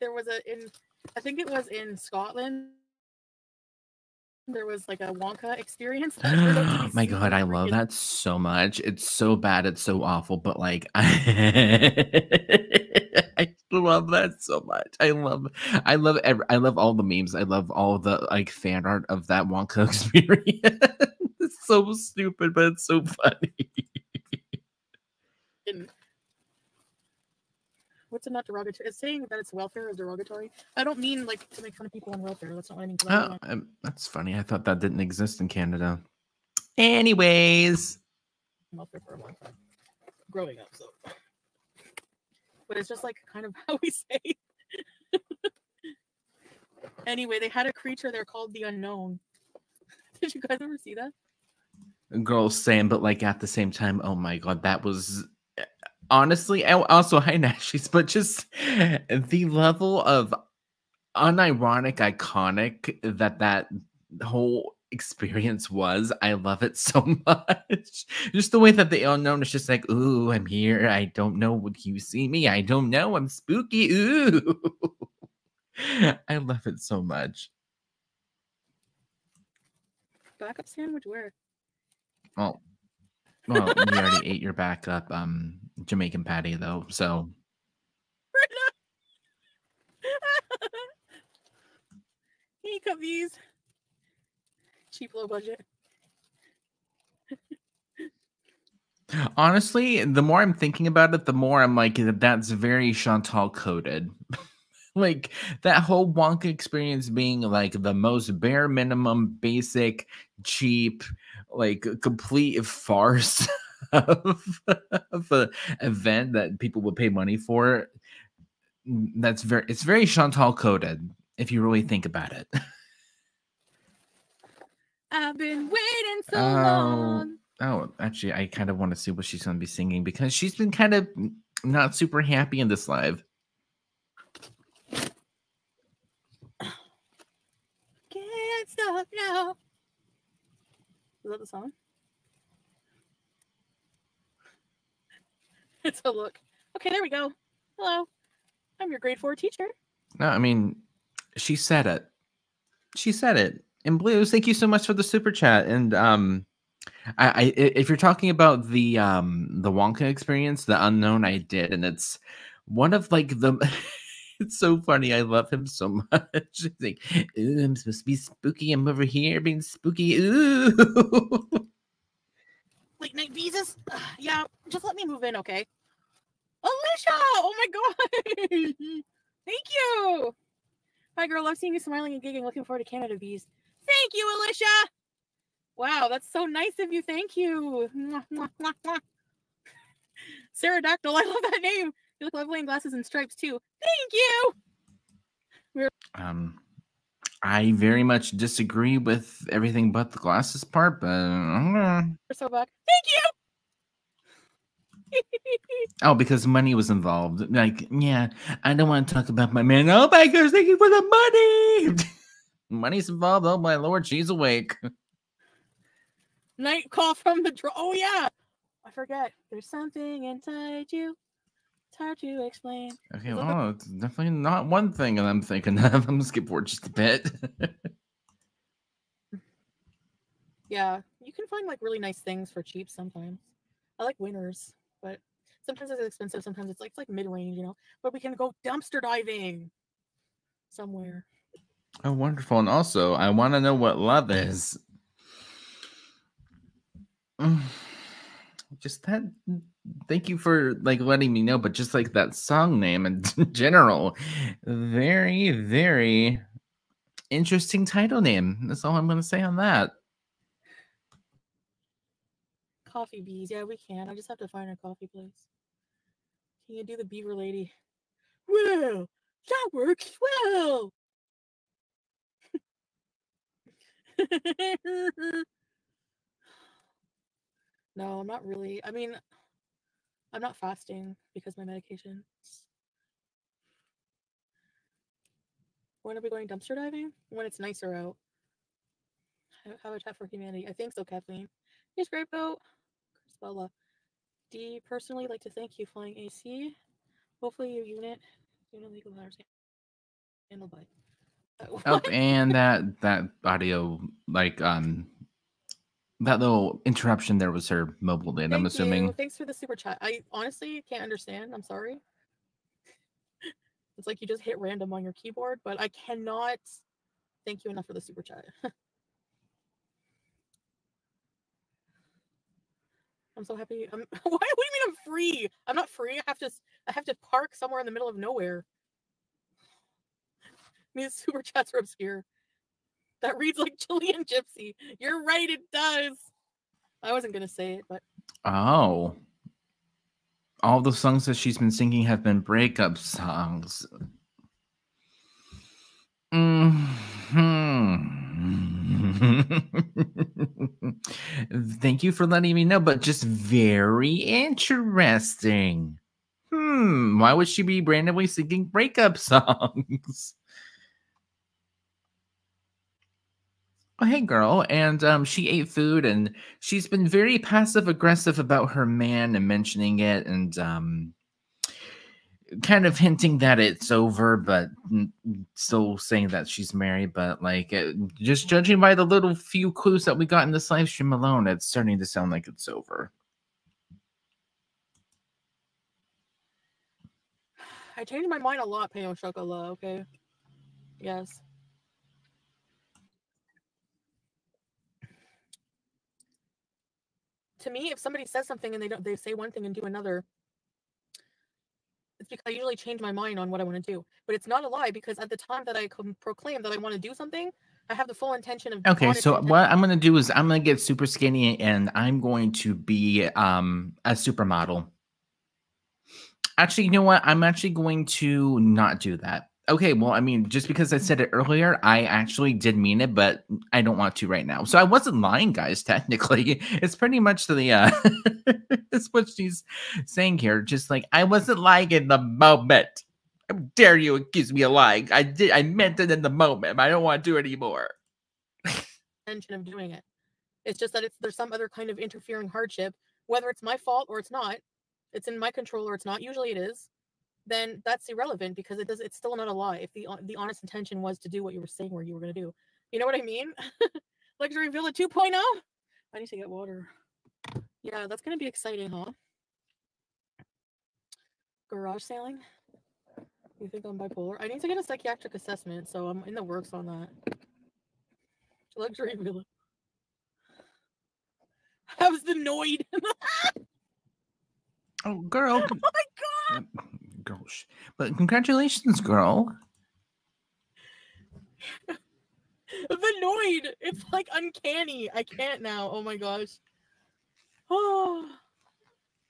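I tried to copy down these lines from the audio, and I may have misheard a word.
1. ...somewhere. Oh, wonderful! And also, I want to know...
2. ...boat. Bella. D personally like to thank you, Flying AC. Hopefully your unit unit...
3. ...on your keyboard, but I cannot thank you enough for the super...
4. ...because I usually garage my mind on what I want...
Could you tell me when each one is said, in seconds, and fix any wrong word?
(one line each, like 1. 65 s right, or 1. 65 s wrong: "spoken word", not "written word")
1. 240 s right
2. 292 s right
3. 314 s right
4. 402 s wrong: "change", not "garage".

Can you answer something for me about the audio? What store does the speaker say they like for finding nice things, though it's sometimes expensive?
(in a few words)
Winners.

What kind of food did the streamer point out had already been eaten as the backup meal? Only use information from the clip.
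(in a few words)
Jamaican patty.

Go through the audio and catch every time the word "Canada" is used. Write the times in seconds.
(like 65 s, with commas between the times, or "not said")
35 s, 182 s.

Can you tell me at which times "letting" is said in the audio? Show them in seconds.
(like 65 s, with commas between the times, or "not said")
251 s, 352 s.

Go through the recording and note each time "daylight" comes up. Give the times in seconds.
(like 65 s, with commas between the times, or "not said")
not said.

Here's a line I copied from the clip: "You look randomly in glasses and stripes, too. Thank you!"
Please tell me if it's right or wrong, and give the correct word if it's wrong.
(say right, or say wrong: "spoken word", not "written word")
wrong: "lovely", not "randomly".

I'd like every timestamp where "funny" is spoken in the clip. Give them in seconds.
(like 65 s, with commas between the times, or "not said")
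23 s, 34 s, 164 s.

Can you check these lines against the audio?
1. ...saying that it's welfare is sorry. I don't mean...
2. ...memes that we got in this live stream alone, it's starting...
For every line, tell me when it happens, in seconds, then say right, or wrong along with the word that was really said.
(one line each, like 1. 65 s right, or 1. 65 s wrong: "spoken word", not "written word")
1. 28 s wrong: "derogatory", not "sorry"
2. 379 s wrong: "clues", not "memes".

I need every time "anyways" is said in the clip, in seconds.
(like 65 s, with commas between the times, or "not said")
36 s, 47 s.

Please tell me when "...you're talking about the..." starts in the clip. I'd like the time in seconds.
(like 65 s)
157 s.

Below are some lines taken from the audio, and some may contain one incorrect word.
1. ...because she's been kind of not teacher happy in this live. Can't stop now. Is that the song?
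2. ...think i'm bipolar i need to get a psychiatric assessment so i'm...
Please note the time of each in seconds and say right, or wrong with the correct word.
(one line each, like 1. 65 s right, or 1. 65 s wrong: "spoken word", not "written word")
1. 130 s wrong: "super", not "teacher"
2. 463 s right.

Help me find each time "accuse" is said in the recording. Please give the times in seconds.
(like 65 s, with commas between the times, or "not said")
434 s.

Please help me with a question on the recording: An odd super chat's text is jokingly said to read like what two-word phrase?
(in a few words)
Chilean gypsy.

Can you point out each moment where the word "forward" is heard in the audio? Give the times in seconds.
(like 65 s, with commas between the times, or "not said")
182 s, 226 s.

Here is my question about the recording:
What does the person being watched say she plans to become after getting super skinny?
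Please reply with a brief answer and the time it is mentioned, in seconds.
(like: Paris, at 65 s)
a supermodel, at 414 s.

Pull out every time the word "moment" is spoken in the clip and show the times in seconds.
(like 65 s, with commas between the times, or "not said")
432 s, 436 s.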